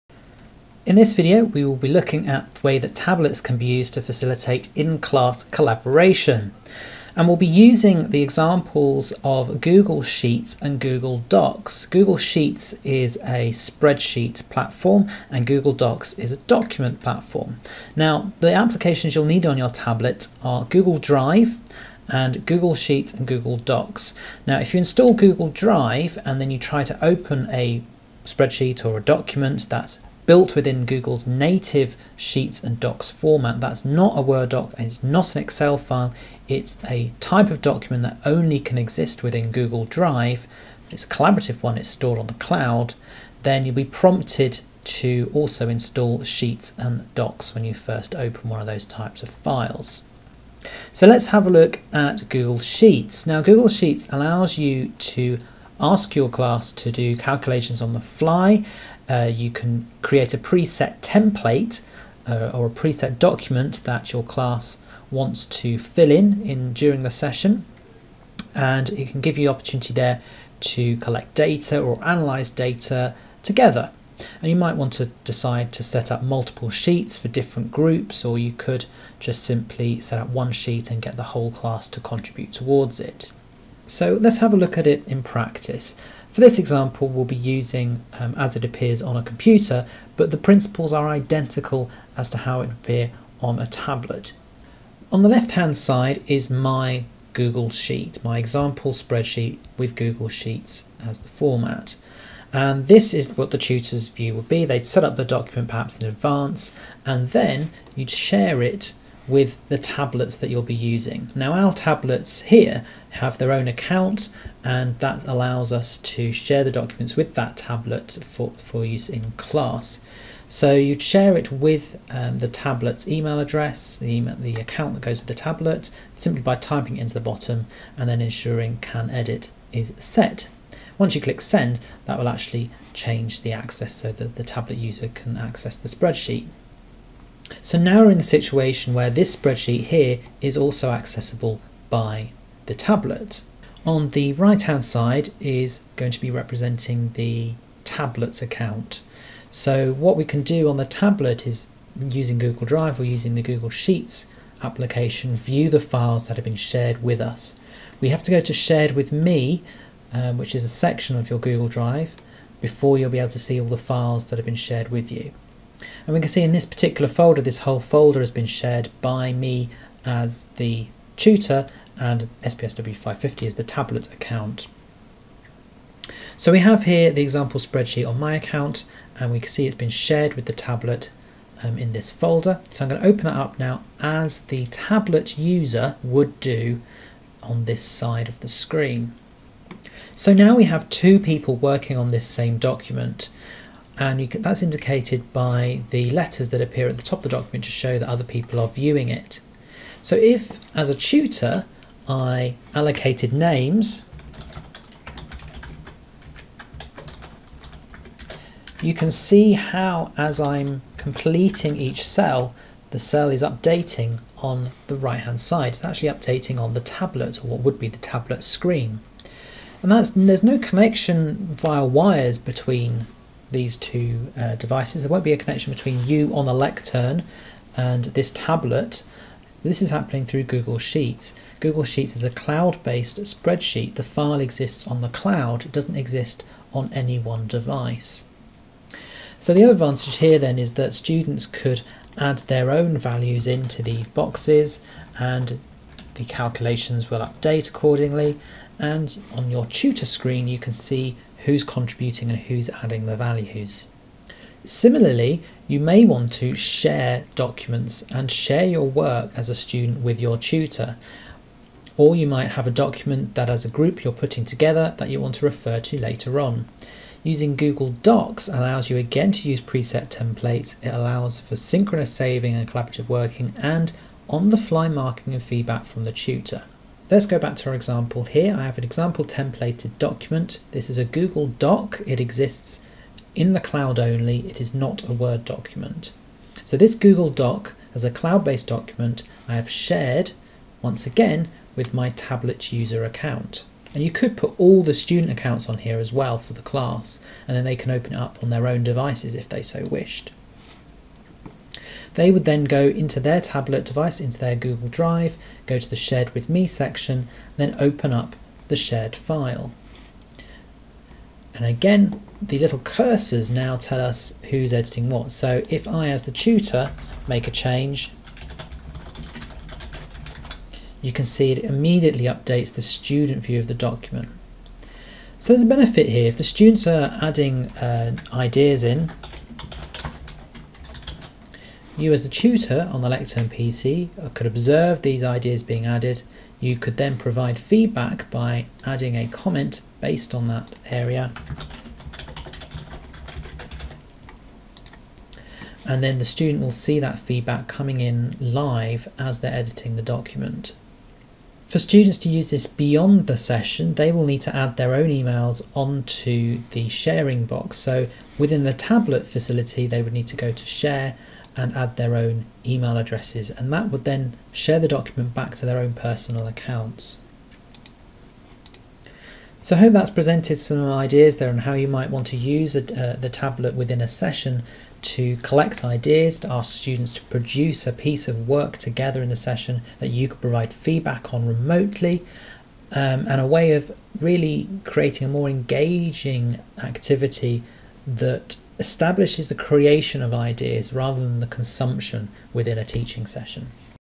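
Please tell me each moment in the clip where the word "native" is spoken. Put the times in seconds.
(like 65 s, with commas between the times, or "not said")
31 s.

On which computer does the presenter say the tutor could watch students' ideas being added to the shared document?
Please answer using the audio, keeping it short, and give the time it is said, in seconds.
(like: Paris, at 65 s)
Lectern PC, at 333 s.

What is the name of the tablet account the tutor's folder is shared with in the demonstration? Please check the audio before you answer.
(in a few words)
SPSW 550.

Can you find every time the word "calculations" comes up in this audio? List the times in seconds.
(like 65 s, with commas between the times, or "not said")
57 s, 246 s.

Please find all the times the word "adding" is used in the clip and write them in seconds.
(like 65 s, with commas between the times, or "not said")
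252 s, 327 s, 338 s.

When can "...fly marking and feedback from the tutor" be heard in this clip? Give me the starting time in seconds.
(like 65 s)
274 s.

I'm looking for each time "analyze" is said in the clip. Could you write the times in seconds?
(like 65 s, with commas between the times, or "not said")
72 s.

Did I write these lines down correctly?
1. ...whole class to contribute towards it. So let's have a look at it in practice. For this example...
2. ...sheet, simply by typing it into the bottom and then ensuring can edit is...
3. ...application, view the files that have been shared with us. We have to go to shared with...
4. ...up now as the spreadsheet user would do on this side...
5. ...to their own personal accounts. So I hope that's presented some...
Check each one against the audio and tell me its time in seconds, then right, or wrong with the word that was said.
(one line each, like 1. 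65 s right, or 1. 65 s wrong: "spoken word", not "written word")
1. 81 s right
2. 125 s wrong: "tablet", not "sheet"
3. 154 s right
4. 183 s wrong: "tablet", not "spreadsheet"
5. 365 s right.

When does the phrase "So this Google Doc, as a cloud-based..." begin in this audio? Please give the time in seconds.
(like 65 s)
286 s.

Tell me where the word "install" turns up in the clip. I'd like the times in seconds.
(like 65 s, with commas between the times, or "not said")
24 s, 45 s.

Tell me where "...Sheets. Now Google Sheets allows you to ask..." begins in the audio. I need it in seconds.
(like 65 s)
52 s.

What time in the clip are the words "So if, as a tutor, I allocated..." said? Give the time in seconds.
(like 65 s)
200 s.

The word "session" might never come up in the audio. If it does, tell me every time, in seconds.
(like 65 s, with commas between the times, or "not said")
67 s, 353 s, 374 s, 379 s, 393 s.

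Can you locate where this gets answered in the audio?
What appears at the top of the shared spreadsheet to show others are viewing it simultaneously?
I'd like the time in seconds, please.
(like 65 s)
196 s.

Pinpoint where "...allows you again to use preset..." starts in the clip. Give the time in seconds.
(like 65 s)
268 s.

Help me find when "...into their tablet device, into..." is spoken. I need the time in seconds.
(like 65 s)
302 s.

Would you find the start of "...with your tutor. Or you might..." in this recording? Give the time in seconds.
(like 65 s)
260 s.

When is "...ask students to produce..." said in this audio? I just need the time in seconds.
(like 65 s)
376 s.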